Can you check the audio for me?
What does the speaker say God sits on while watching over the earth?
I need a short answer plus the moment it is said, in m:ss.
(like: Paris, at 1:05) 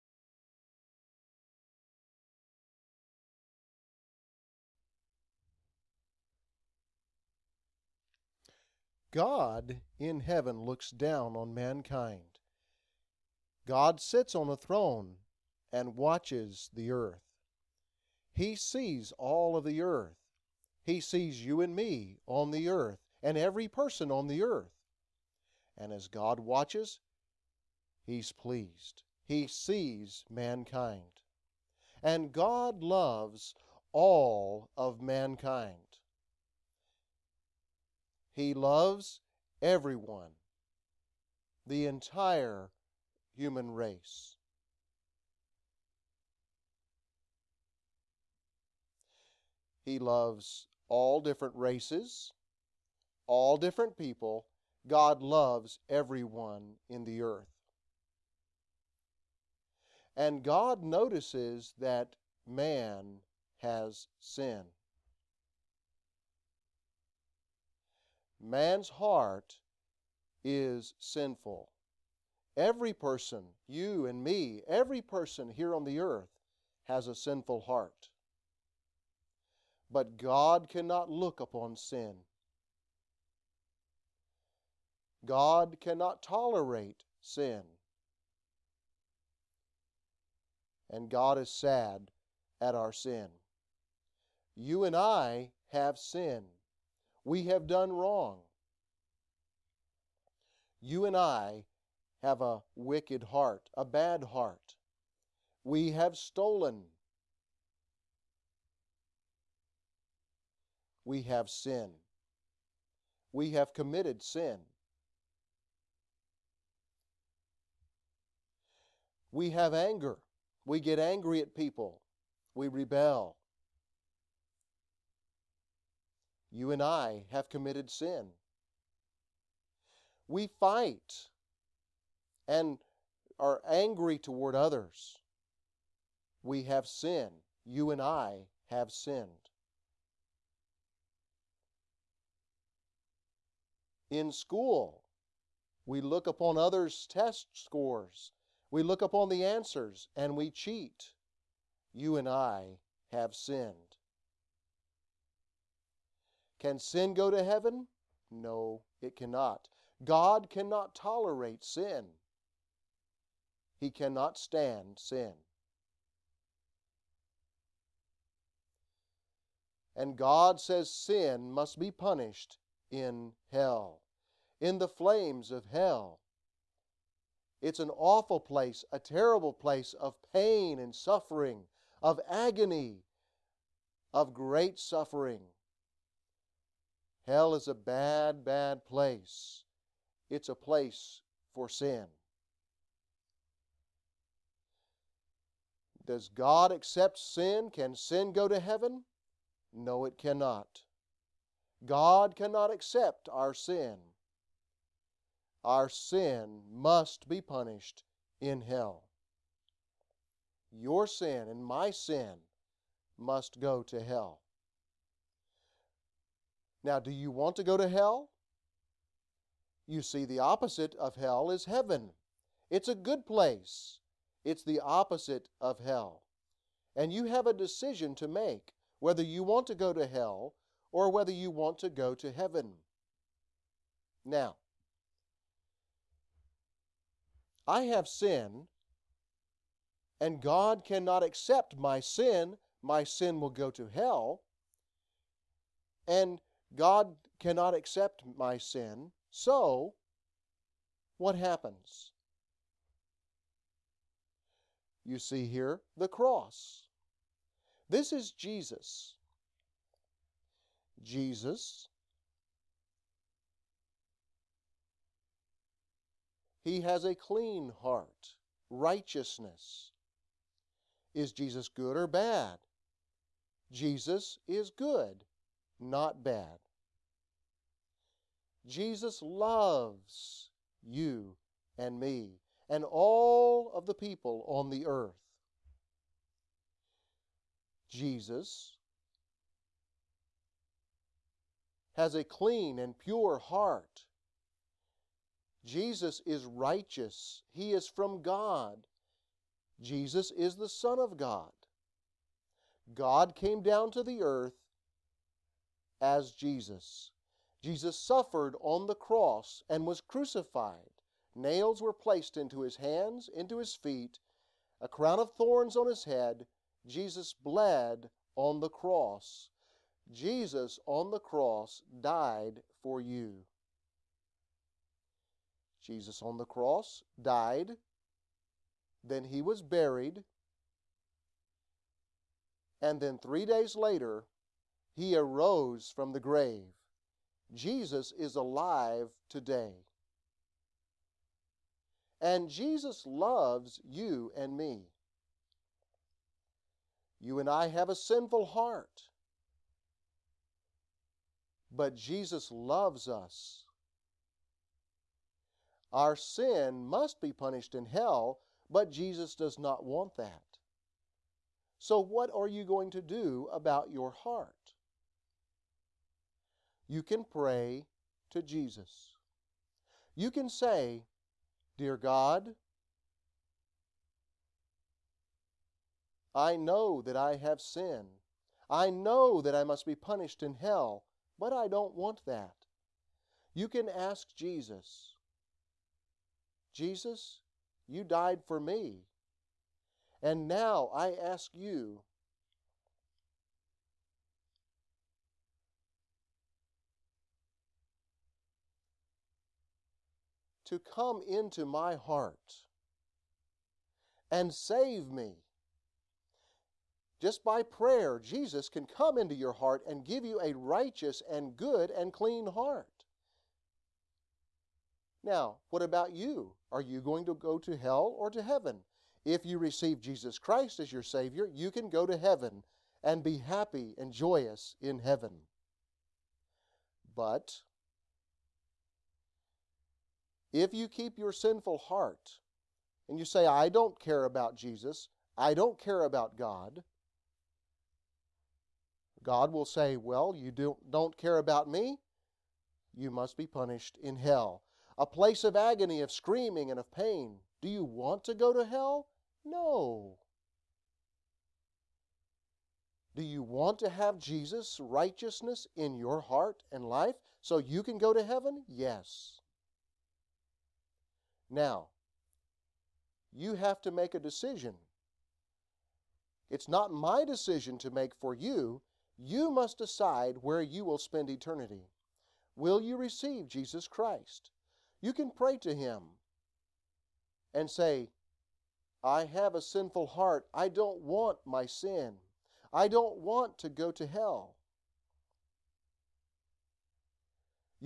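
a throne, at 0:14.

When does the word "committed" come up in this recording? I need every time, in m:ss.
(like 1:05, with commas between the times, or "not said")
1:53, 2:07.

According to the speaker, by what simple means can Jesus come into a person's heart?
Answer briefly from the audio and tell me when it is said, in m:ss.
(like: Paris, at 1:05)
prayer, at 6:47.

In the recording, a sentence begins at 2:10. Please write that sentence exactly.
We fight and are angry toward others.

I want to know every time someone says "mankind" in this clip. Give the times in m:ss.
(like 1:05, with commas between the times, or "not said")
0:11, 0:30, 0:35.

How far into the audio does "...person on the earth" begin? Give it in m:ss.
0:23.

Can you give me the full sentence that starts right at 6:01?
So, what are you going to do about your heart?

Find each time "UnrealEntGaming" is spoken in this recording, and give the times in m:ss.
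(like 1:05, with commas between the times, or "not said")
not said.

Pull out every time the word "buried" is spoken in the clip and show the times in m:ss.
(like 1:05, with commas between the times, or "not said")
5:29.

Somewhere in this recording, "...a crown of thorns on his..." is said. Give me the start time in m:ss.
5:14.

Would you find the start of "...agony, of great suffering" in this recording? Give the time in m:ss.
3:02.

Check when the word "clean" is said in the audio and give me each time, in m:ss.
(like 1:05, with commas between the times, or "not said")
4:27, 4:52, 6:52.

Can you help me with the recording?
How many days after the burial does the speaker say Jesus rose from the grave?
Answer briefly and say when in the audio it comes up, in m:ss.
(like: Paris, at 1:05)
3, at 5:33.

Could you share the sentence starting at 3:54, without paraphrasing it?
Now, I have sin, and God cannot accept my sin.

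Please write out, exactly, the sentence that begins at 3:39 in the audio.
You see, the opposite of hell is heaven.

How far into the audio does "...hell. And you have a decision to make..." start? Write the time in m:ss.
3:45.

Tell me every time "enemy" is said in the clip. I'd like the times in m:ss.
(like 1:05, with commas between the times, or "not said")
not said.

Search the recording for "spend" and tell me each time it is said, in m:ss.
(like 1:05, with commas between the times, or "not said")
7:50.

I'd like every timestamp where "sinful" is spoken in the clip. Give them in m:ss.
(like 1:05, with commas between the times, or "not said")
1:10, 1:17, 5:47, 7:11, 7:59.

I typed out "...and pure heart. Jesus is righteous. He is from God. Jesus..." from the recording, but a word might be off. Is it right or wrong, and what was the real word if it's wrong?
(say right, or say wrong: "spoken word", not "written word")
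right.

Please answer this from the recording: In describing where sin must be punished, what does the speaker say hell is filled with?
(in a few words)
flames.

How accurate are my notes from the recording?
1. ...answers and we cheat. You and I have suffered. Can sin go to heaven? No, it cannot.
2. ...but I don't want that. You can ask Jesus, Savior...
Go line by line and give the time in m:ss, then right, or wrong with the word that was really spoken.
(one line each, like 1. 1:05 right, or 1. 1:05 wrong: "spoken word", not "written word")
1. 2:29 wrong: "sinned", not "suffered"
2. 6:21 wrong: "Jesus", not "Savior".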